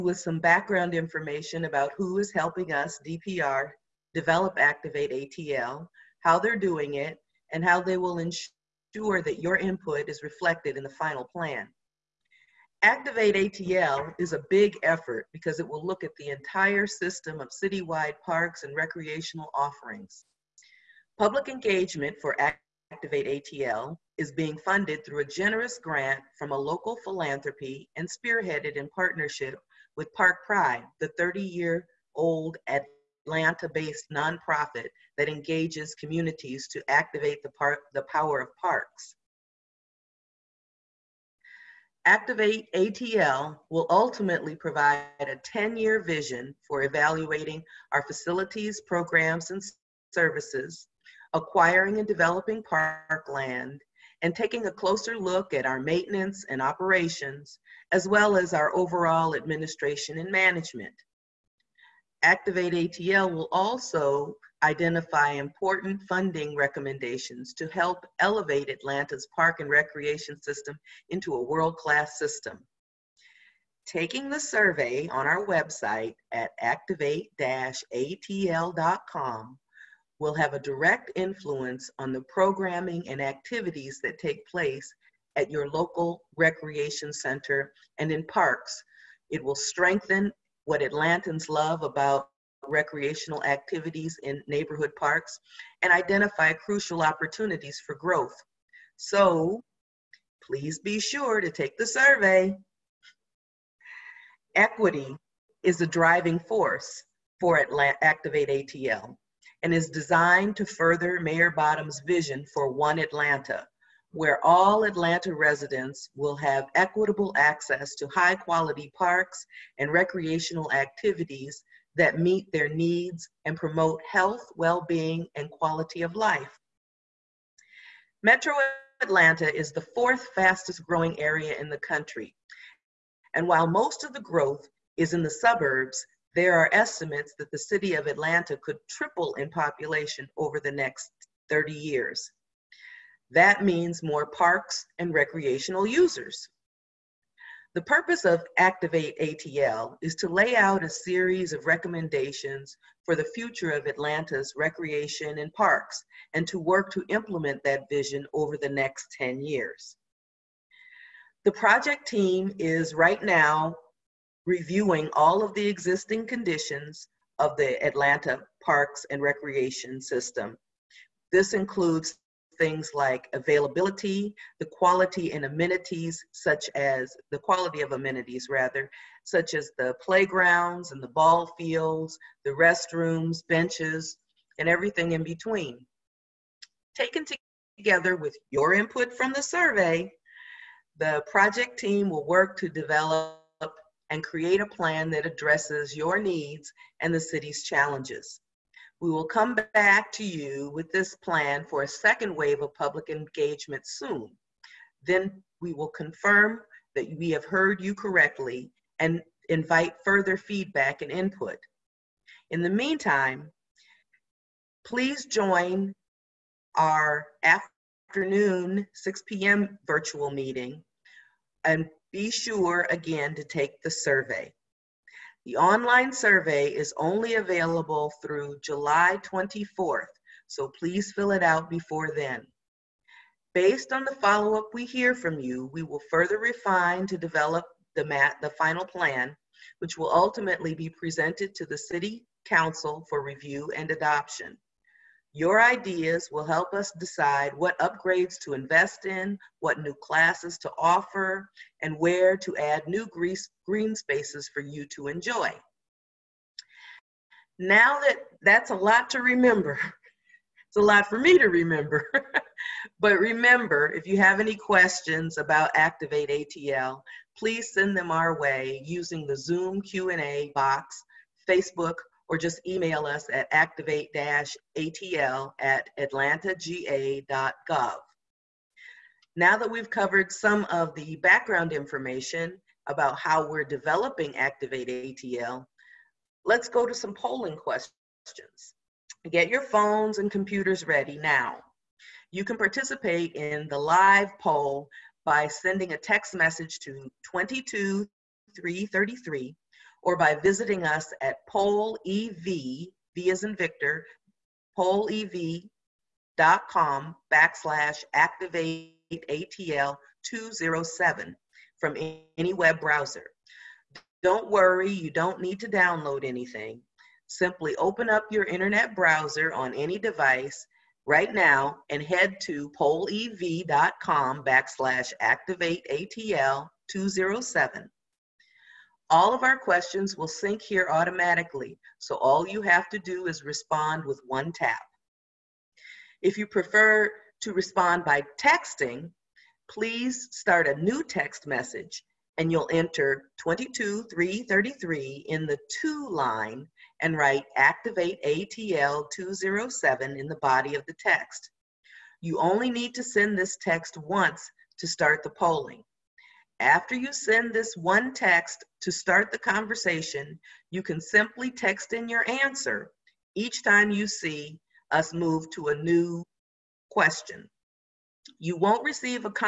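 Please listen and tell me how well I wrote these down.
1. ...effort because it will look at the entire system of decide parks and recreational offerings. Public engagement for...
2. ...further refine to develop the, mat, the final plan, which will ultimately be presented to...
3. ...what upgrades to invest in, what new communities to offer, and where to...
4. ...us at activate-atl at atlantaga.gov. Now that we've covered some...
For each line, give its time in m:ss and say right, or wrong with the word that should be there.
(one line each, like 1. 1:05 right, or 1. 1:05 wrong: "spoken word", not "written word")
1. 0:14 wrong: "citywide", not "decide"
2. 3:56 right
3. 4:07 wrong: "classes", not "communities"
4. 4:33 right.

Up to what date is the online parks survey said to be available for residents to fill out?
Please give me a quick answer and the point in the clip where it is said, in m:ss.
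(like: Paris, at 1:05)
July 24, at 3:48.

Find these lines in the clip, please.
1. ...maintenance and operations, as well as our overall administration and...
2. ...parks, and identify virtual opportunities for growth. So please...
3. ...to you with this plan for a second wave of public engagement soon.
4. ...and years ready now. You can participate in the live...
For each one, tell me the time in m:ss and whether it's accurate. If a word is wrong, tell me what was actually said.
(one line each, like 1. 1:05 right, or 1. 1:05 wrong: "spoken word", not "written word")
1. 0:55 right
2. 1:34 wrong: "crucial", not "virtual"
3. 3:20 right
4. 4:50 wrong: "computers", not "years".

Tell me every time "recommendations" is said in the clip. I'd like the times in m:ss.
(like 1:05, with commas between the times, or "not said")
1:06, 2:31.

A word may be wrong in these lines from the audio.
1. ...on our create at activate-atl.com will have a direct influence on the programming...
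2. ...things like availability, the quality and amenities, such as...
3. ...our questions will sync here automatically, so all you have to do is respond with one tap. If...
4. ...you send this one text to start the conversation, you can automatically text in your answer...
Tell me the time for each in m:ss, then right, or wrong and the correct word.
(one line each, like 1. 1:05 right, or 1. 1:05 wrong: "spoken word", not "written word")
1. 1:15 wrong: "website", not "create"
2. 2:52 right
3. 5:29 right
4. 5:56 wrong: "simply", not "automatically".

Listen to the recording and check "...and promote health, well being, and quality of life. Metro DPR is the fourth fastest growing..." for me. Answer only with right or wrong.
wrong.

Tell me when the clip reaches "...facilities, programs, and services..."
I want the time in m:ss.
0:48.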